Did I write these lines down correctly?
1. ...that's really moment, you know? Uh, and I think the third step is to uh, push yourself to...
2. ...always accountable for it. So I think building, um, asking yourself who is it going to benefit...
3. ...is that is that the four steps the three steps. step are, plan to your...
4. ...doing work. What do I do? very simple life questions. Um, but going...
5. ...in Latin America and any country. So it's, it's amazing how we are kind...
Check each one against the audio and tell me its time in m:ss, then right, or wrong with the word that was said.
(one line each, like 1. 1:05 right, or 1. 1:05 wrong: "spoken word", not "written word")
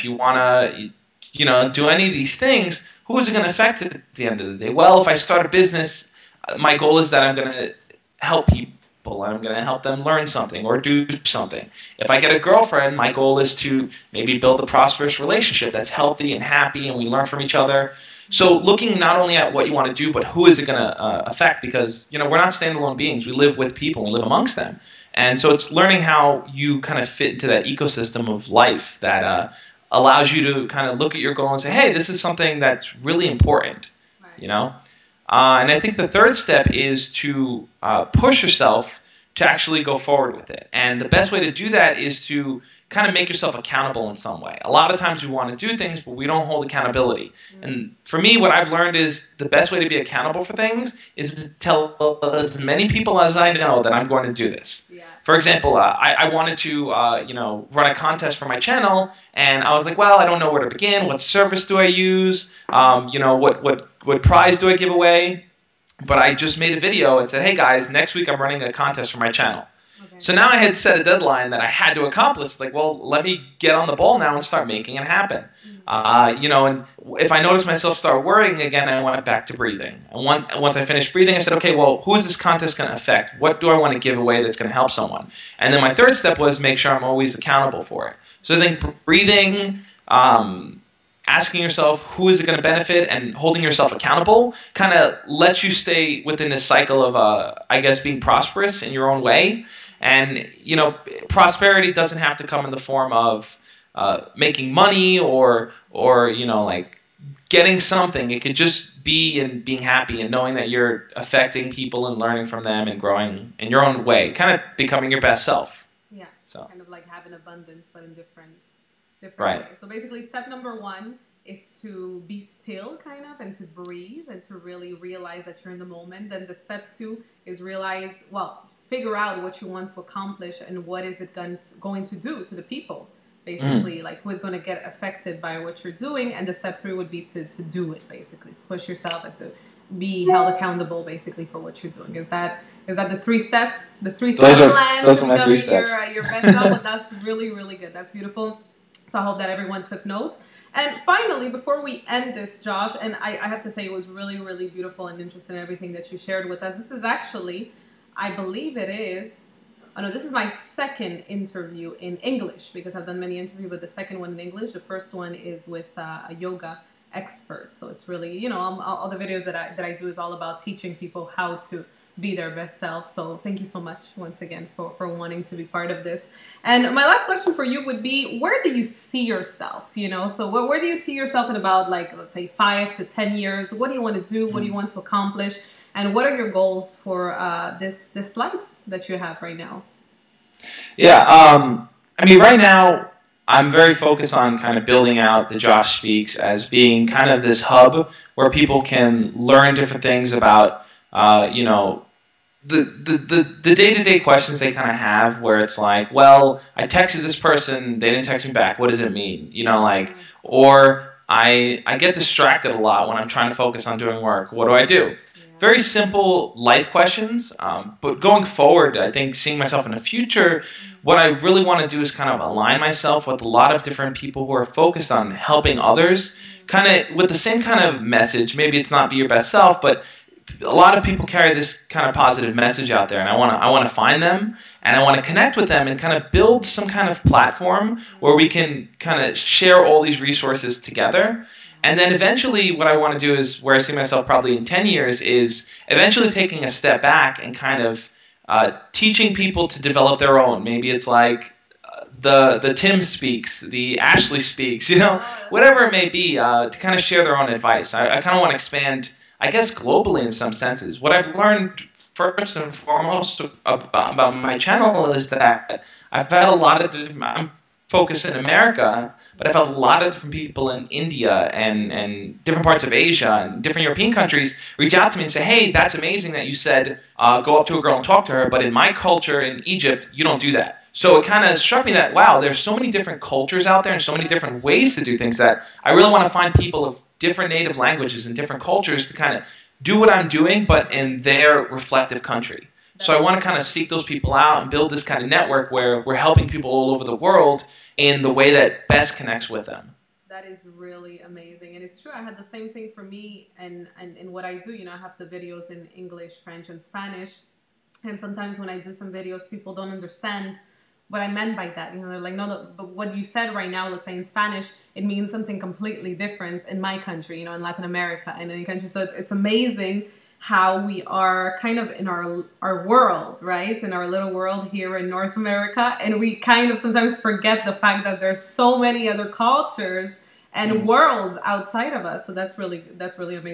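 1. 0:32 wrong: "important", not "moment"
2. 1:27 wrong: "breathing", not "building"
3. 2:22 wrong: "three", not "four"
4. 3:33 right
5. 5:17 right.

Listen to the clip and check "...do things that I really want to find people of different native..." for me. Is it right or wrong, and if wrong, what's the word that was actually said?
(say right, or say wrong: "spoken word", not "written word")
right.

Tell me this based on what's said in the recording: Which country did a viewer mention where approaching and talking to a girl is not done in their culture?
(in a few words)
Egypt.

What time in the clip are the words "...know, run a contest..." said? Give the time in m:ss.
0:57.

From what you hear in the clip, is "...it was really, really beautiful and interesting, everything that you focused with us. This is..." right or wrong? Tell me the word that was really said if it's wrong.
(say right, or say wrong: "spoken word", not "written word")
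wrong: "shared", not "focused".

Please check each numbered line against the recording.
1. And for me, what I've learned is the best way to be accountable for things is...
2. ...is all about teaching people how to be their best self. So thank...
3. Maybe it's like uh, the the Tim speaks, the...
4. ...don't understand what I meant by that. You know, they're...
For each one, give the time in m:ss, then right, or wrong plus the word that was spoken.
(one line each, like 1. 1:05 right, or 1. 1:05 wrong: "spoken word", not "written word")
1. 0:47 right
2. 2:50 right
3. 4:10 right
4. 5:09 right.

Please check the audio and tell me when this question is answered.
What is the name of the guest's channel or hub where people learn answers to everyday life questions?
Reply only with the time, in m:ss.
3:15.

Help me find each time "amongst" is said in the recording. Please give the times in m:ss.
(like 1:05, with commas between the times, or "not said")
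0:24.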